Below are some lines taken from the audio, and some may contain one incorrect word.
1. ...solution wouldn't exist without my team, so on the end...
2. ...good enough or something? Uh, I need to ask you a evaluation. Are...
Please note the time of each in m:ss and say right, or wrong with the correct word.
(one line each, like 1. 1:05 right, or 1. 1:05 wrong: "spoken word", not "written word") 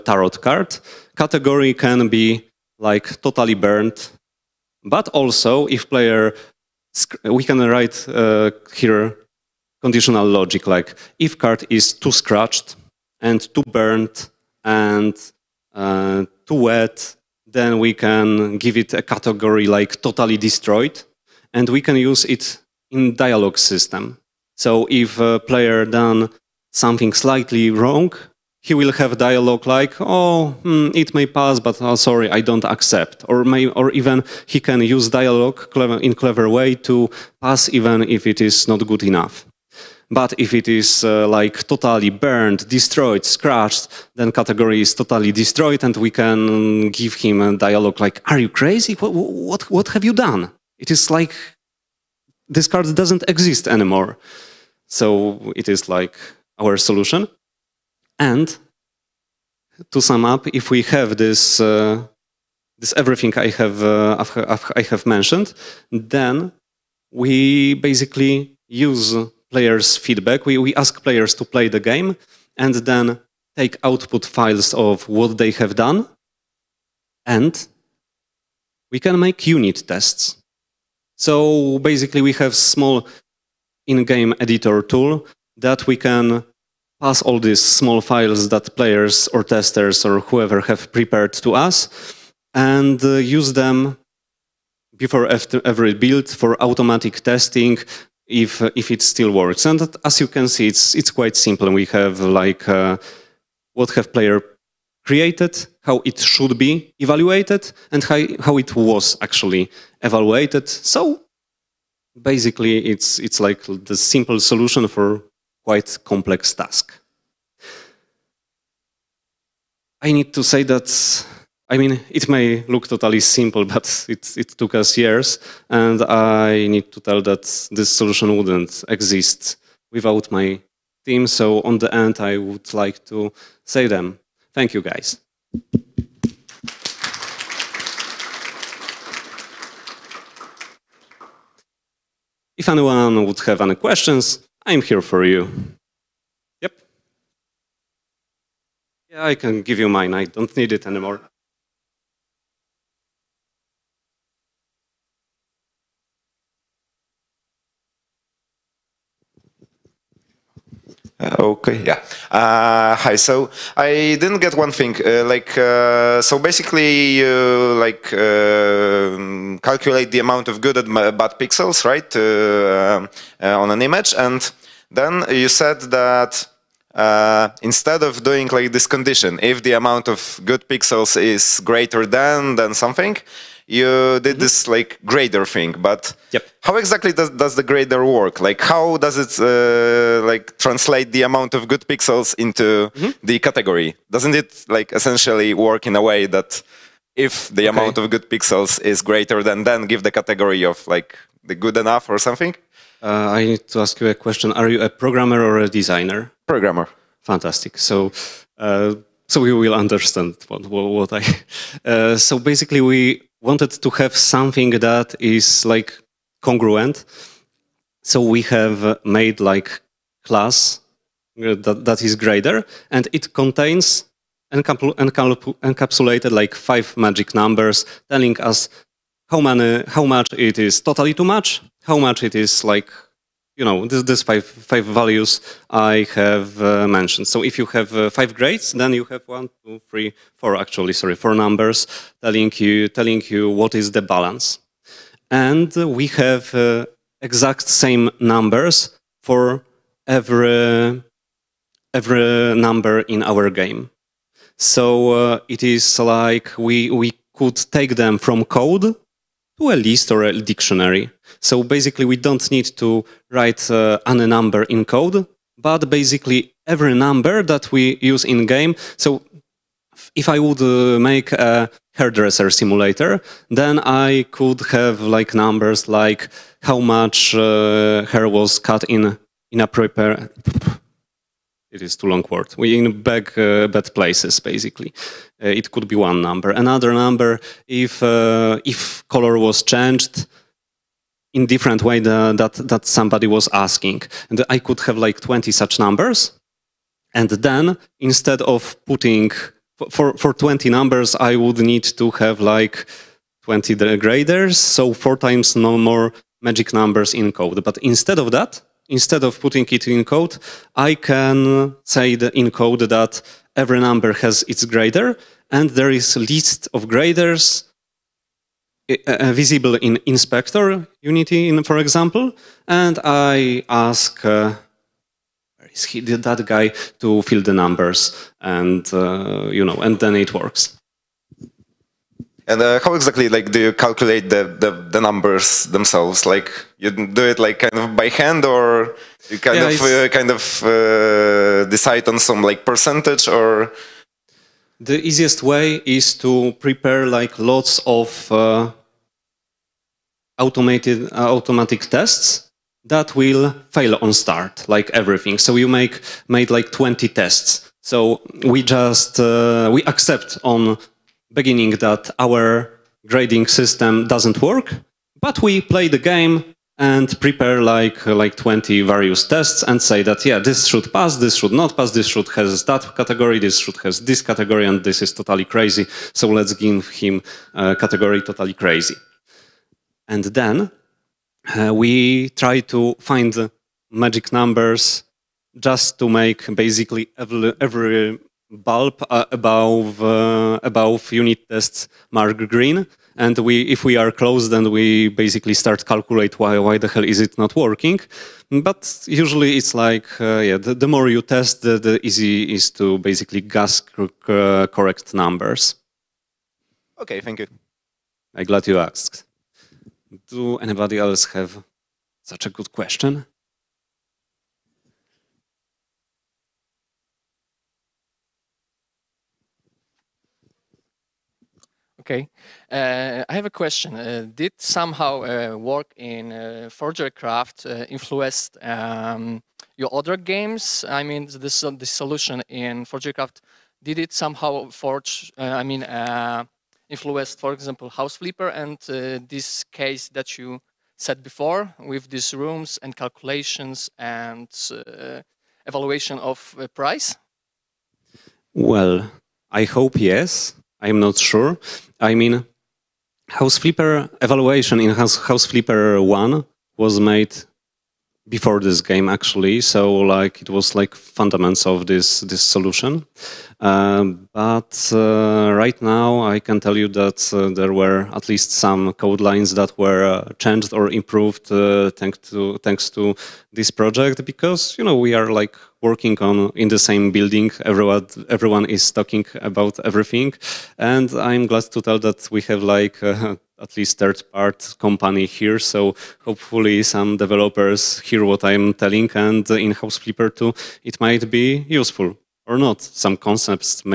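1. 2:07 right
2. 3:21 wrong: "question", not "evaluation".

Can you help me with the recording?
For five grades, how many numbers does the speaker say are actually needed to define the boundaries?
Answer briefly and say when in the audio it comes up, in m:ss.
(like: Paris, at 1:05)
4, at 4:01.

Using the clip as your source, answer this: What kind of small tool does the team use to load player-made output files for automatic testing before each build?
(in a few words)
in-game editor tool.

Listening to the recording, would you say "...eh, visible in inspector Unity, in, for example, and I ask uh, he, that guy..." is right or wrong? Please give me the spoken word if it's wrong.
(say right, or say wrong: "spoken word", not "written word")
right.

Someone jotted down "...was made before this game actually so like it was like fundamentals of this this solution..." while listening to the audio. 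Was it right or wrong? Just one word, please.
right.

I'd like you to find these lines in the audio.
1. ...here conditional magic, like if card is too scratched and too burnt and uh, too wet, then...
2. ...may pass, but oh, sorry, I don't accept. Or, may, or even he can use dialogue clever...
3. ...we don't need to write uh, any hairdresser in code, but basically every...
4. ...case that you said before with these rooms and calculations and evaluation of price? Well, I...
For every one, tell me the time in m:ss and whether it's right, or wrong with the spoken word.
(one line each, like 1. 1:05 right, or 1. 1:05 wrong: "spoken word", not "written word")
1. 0:08 wrong: "logic", not "magic"
2. 0:31 right
3. 4:22 wrong: "number", not "hairdresser"
4. 7:19 right.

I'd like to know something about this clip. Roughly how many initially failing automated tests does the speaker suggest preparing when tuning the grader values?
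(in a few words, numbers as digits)
20.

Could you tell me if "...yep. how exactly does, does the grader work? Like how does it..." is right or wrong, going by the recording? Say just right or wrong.
right.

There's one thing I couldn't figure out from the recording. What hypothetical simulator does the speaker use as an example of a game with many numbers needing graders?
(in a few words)
hairdresser simulator.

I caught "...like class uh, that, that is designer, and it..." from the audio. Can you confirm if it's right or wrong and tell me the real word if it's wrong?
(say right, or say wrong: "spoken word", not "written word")
wrong: "grader", not "designer".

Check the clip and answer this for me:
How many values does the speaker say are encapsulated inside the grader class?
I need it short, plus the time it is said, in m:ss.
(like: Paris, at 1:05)
5, at 3:46.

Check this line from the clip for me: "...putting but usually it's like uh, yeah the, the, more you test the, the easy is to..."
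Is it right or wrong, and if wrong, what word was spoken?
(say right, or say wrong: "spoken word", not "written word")
wrong: "working", not "putting".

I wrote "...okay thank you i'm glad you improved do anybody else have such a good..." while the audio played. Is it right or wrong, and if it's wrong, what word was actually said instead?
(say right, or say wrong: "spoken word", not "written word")
wrong: "asked", not "improved".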